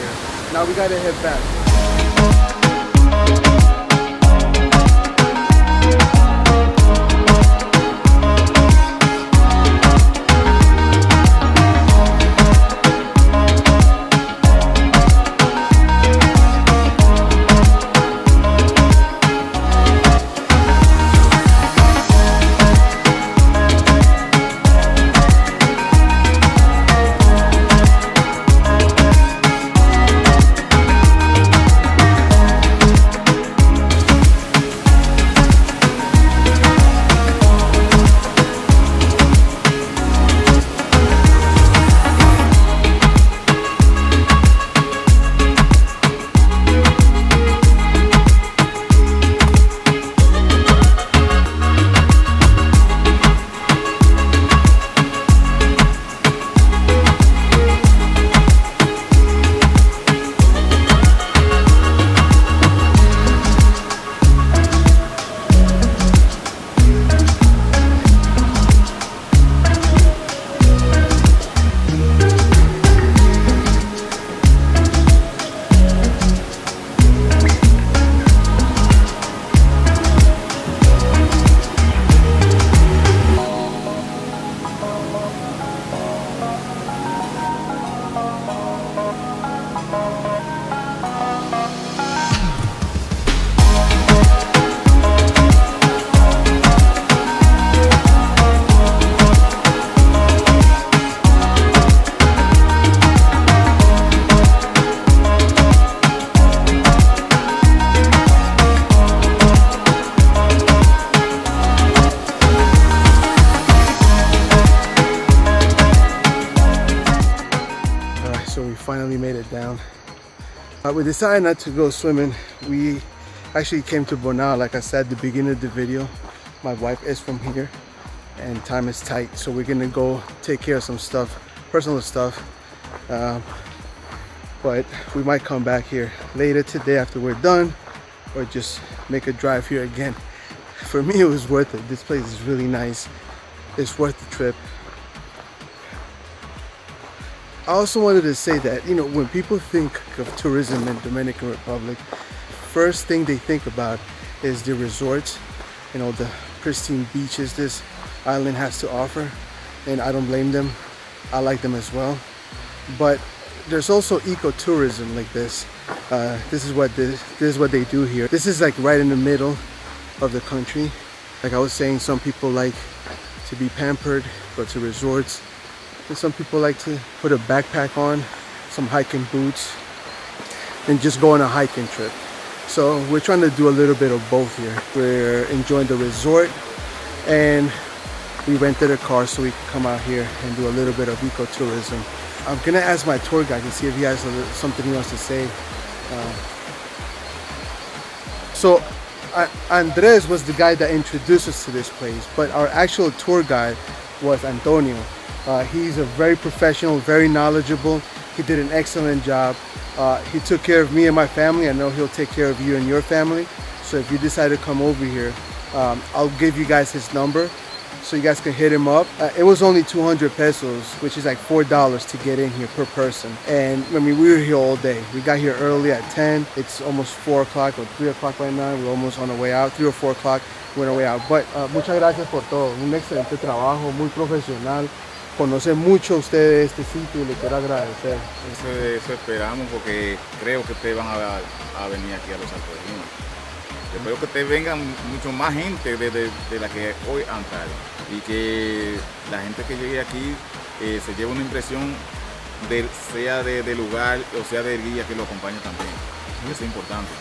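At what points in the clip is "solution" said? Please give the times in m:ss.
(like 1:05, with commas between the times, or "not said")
not said.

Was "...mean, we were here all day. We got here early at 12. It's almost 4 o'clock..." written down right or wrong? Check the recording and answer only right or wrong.
wrong.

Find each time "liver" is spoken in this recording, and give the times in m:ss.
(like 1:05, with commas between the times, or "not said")
not said.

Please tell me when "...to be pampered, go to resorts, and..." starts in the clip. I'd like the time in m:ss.
2:53.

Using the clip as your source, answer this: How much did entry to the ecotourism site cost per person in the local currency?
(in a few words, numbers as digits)
200 pesos.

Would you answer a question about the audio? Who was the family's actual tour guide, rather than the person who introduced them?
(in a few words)
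Antonio.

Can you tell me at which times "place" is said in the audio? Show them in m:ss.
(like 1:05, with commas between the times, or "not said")
2:22, 3:21.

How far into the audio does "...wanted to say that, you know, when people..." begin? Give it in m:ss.
2:27.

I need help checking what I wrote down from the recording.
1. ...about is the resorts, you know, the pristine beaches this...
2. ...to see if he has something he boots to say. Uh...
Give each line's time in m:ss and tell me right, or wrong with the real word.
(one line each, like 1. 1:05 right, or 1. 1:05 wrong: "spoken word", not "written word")
1. 2:33 right
2. 3:13 wrong: "wants", not "boots".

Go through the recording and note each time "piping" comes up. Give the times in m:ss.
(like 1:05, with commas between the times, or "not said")
not said.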